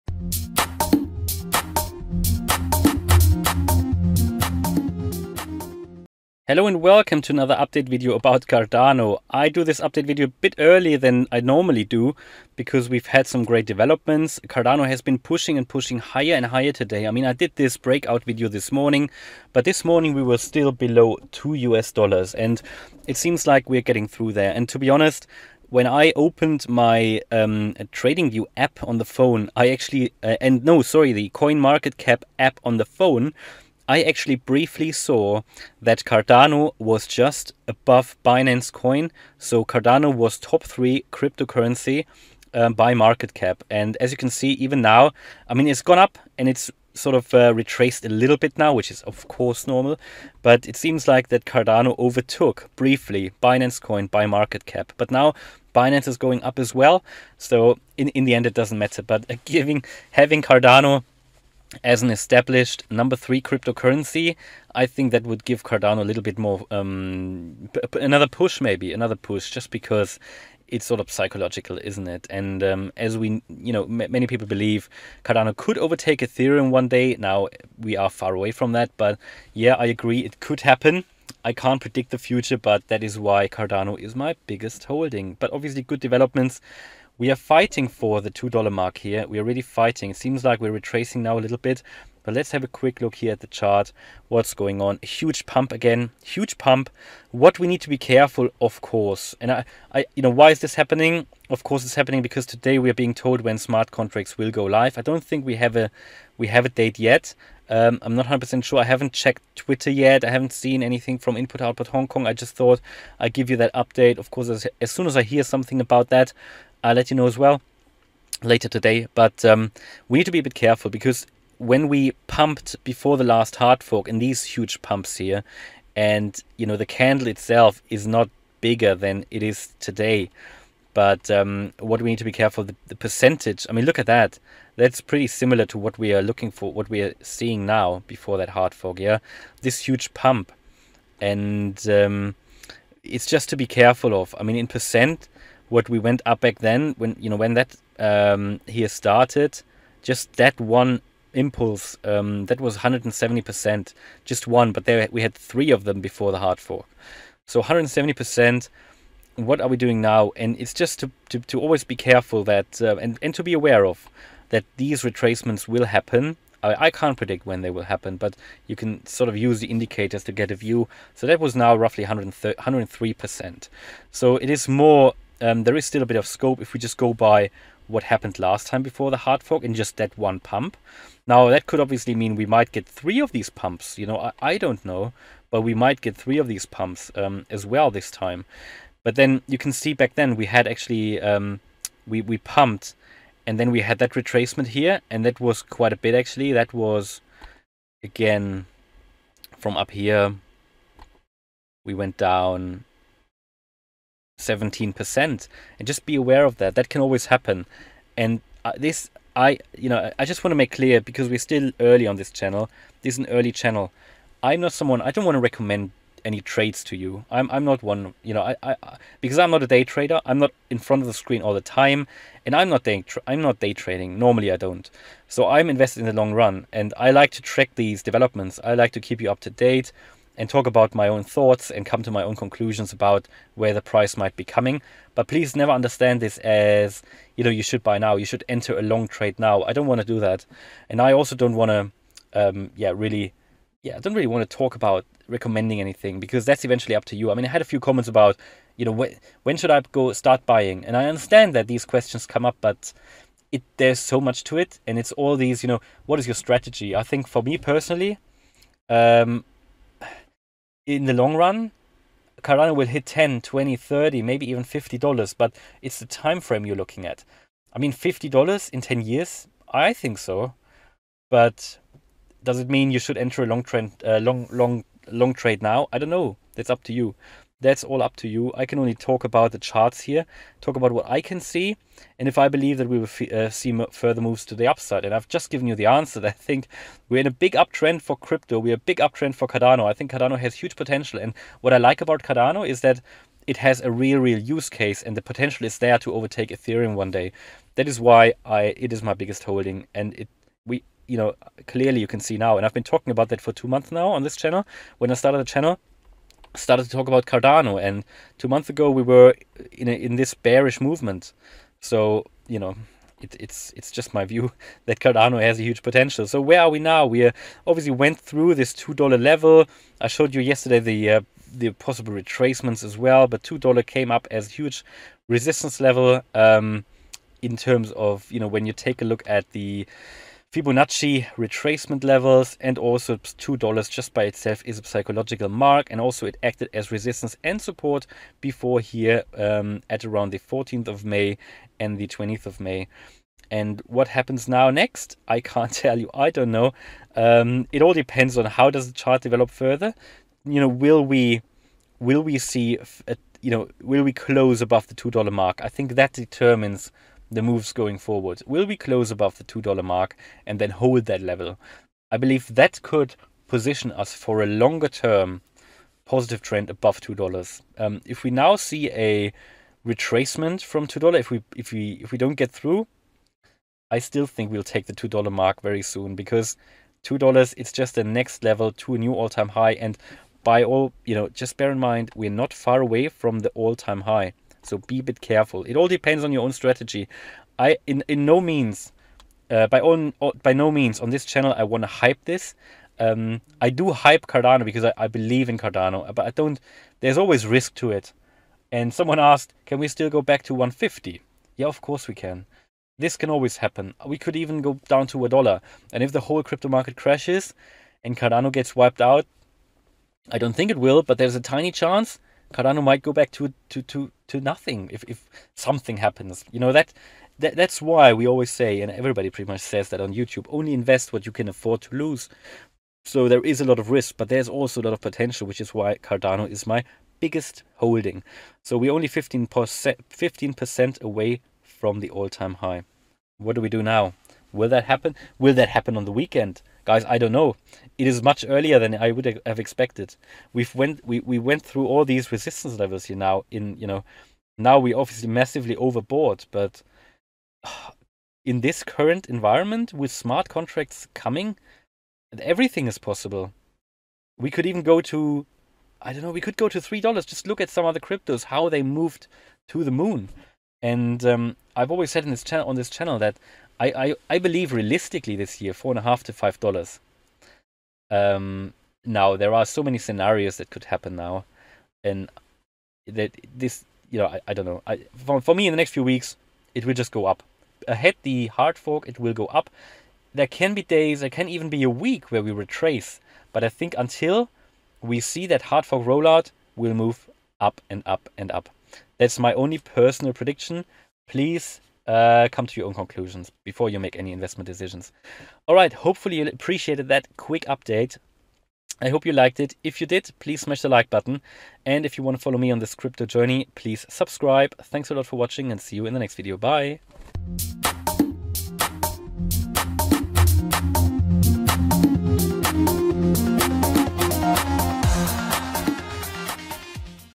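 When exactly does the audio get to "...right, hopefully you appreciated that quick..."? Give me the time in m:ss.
8:15.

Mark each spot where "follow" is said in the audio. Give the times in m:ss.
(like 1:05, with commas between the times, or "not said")
8:22.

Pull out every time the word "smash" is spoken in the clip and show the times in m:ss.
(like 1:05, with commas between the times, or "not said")
8:20.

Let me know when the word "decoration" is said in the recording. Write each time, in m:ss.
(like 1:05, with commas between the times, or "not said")
not said.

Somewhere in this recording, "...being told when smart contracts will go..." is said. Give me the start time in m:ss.
1:42.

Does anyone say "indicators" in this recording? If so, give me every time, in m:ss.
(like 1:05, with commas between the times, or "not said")
2:49.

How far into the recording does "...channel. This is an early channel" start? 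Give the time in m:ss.
3:32.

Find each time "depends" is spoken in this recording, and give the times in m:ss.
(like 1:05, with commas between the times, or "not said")
5:47, 6:25.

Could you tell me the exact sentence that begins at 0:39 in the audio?
So Cardano was top three cryptocurrency um, by market cap.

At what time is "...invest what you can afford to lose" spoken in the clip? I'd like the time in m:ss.
7:00.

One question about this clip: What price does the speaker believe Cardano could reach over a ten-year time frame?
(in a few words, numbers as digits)
$50.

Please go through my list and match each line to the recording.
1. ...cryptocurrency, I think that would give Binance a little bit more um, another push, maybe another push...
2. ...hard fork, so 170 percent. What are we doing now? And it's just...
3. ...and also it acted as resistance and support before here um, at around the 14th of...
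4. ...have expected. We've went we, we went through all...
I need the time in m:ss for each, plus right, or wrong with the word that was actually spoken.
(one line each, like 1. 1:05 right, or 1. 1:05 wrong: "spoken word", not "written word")
1. 1:03 wrong: "Cardano", not "Binance"
2. 2:36 right
3. 5:35 right
4. 7:19 right.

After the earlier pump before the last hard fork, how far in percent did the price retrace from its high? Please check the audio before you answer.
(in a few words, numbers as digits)
17%.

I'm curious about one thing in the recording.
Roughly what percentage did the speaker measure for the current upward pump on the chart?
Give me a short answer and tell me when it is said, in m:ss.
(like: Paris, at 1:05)
103%, at 2:51.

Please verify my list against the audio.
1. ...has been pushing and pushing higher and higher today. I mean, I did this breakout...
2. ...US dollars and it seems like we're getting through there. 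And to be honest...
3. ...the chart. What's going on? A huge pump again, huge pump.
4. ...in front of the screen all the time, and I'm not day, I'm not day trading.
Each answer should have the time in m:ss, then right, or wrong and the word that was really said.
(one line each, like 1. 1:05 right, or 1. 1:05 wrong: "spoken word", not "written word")
1. 0:14 right
2. 0:21 right
3. 1:33 right
4. 3:40 right.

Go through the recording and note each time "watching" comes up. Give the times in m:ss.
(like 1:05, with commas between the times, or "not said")
8:25.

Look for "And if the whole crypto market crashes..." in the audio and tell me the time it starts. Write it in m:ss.
6:45.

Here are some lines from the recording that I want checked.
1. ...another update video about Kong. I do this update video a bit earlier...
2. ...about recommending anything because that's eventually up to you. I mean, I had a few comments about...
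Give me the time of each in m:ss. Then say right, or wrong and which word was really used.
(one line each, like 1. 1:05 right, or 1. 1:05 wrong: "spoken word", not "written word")
1. 0:07 wrong: "Cardano", not "Kong"
2. 4:04 right.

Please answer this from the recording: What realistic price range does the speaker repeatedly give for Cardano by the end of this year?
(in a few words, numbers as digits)
$4.50 to $5.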